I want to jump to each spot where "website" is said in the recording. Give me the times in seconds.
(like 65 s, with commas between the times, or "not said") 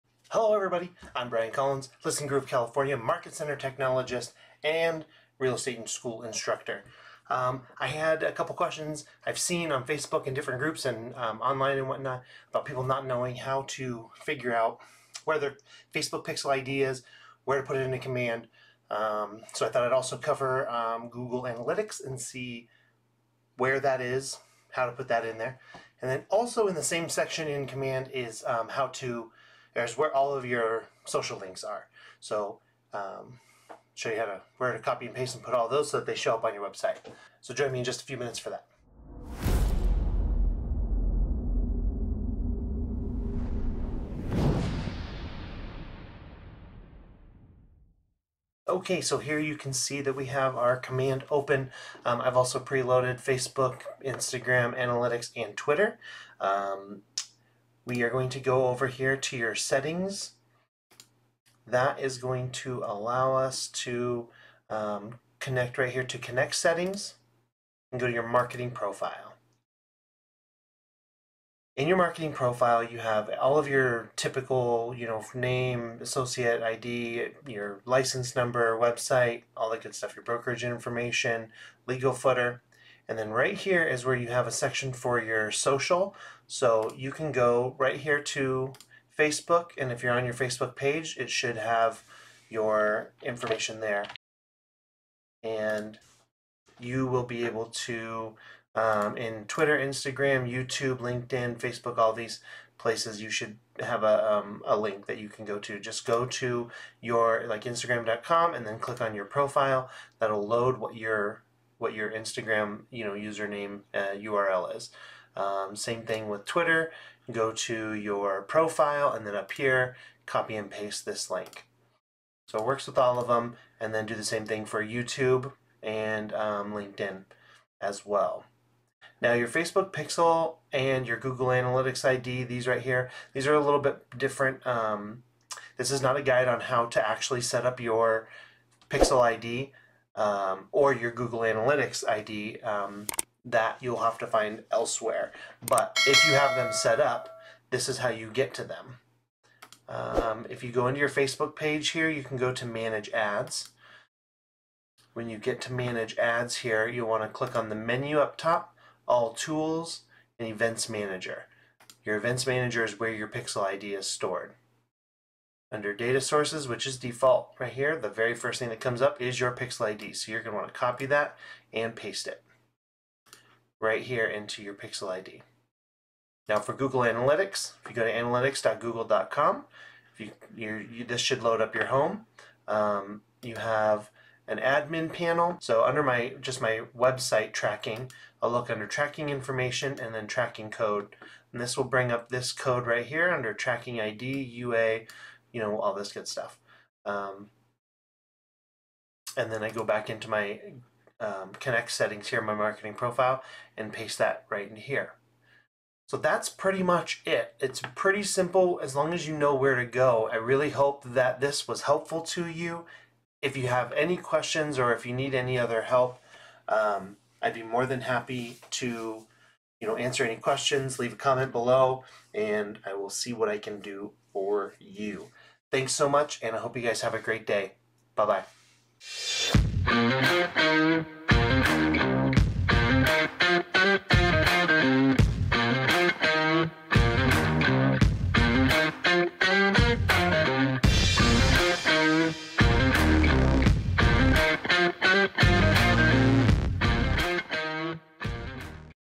36 s, 78 s, 186 s.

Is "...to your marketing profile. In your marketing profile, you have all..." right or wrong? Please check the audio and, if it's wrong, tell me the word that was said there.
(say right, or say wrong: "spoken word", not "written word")
right.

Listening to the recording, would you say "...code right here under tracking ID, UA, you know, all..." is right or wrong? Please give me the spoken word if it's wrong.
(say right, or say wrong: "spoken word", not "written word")
right.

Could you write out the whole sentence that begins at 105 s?
Just go to your, like, Instagram.com and then click on your profile.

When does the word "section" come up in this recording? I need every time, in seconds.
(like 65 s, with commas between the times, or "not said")
27 s, 84 s.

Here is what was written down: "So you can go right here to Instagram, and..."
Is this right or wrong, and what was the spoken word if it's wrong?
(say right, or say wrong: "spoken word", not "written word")
wrong: "Facebook", not "Instagram".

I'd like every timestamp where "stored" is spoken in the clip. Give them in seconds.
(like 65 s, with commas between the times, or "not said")
164 s.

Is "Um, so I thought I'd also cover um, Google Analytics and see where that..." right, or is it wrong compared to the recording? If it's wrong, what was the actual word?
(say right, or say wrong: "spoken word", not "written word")
right.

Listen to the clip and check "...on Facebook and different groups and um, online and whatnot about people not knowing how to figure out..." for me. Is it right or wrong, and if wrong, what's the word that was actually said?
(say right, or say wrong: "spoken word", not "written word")
right.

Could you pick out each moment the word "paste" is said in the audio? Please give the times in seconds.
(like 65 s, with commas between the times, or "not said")
35 s, 120 s, 171 s, 203 s.